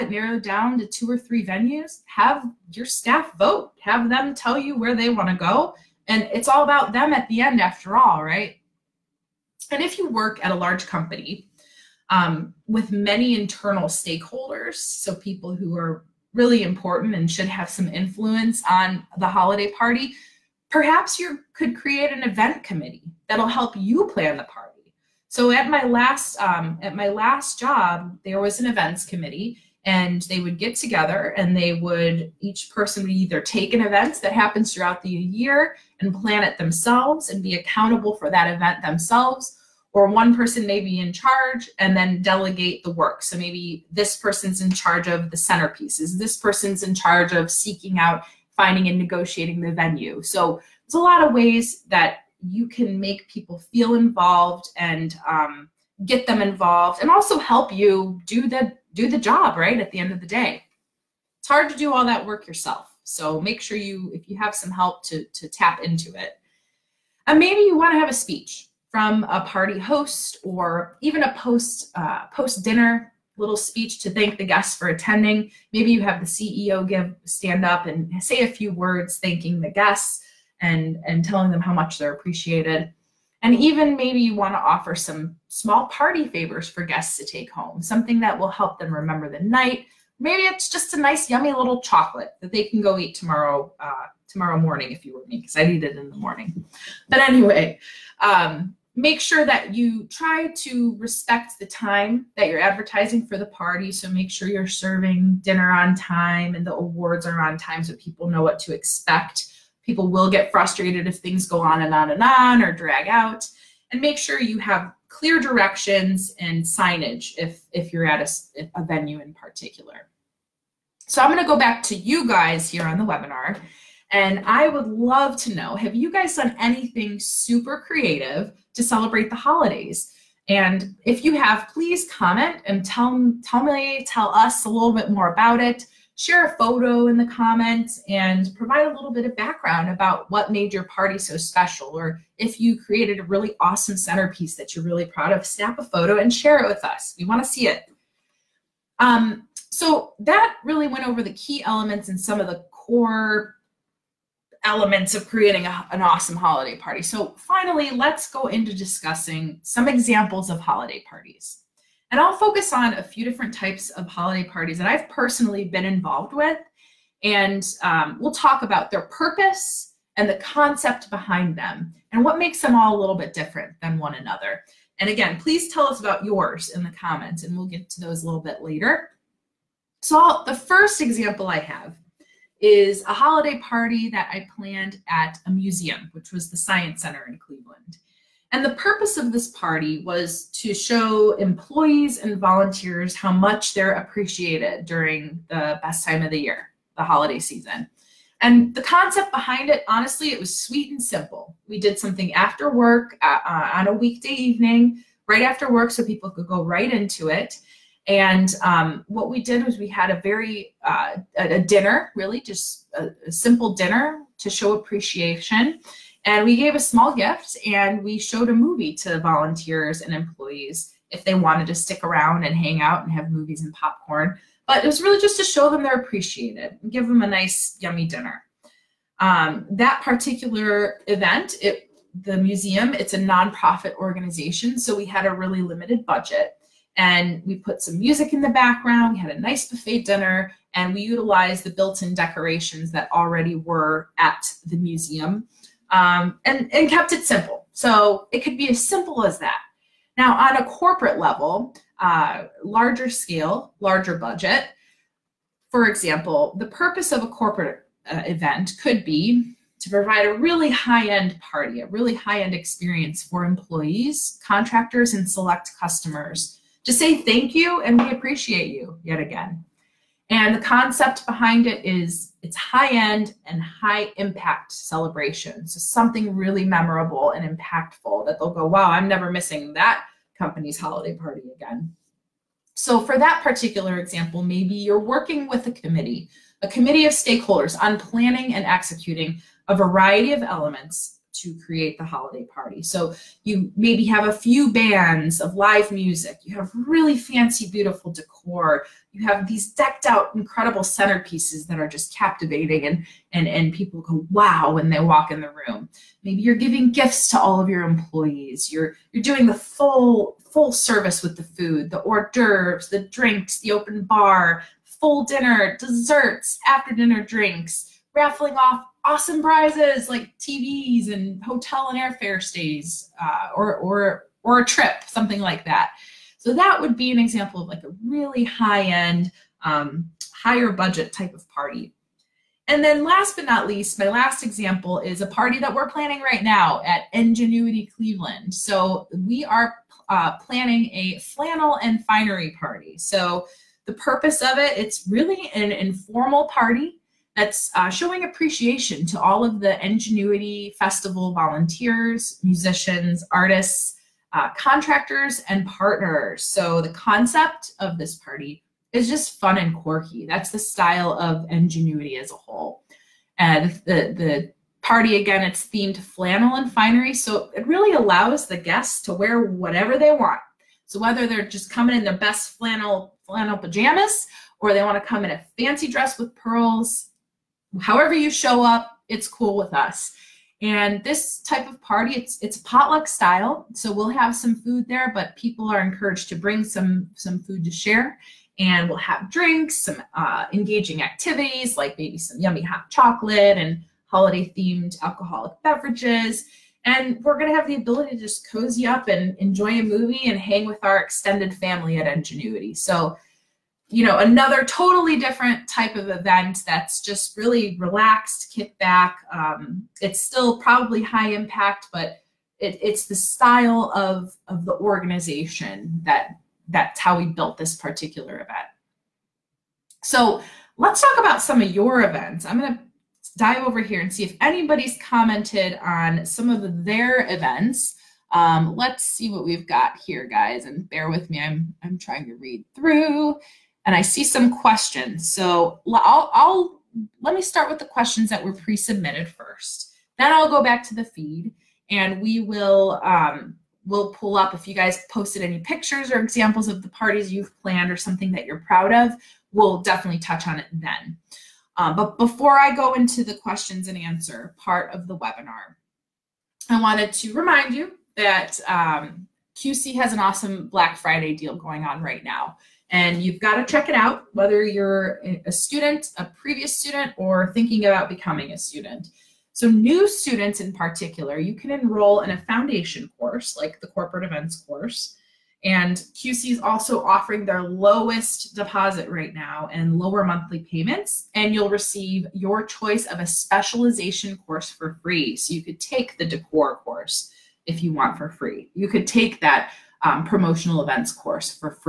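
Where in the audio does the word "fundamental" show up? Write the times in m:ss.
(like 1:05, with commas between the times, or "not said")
not said.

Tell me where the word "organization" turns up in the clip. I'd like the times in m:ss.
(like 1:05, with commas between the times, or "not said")
3:53, 6:54.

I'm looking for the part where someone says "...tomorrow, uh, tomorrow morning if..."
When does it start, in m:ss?
1:33.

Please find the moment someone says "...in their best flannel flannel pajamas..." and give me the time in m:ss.
6:11.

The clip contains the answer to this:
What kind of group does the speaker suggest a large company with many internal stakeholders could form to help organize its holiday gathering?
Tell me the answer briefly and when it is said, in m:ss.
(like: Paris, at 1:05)
event committee, at 0:22.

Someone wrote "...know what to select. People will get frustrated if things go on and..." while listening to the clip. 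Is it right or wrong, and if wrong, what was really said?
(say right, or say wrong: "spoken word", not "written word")
wrong: "expect", not "select".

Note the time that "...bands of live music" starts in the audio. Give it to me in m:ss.
4:54.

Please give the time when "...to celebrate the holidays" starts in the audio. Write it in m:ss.
2:08.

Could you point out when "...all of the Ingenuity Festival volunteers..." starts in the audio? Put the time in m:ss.
5:49.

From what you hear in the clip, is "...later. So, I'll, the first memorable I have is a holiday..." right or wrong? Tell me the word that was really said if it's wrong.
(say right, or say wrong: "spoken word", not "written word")
wrong: "example", not "memorable".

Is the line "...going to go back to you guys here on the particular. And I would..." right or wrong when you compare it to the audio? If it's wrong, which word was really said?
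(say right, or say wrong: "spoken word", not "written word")
wrong: "webinar", not "particular".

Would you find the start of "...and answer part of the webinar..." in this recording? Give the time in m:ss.
7:33.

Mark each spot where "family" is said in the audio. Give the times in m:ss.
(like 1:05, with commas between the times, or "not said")
6:41.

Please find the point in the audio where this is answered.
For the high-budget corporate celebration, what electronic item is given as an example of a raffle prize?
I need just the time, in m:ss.
5:20.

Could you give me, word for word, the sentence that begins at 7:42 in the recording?
And you've got to check it out, whether you're a student, a previous student, or thinking about becoming a student.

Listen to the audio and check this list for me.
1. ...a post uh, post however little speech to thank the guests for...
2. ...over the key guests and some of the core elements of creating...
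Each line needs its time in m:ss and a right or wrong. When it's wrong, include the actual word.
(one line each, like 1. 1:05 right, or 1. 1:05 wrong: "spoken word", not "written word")
1. 1:11 wrong: "dinner", not "however"
2. 2:31 wrong: "elements", not "guests".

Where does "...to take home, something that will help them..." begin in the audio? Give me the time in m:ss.
1:27.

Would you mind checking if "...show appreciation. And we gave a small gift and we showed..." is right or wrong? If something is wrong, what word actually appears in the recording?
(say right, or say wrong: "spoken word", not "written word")
right.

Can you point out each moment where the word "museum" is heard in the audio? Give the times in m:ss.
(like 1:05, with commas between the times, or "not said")
3:05, 3:52, 4:04.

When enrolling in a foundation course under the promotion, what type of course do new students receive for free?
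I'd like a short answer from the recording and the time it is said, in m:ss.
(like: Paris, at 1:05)
specialization course, at 8:03.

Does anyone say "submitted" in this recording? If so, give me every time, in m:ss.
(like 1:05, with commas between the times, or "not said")
7:18.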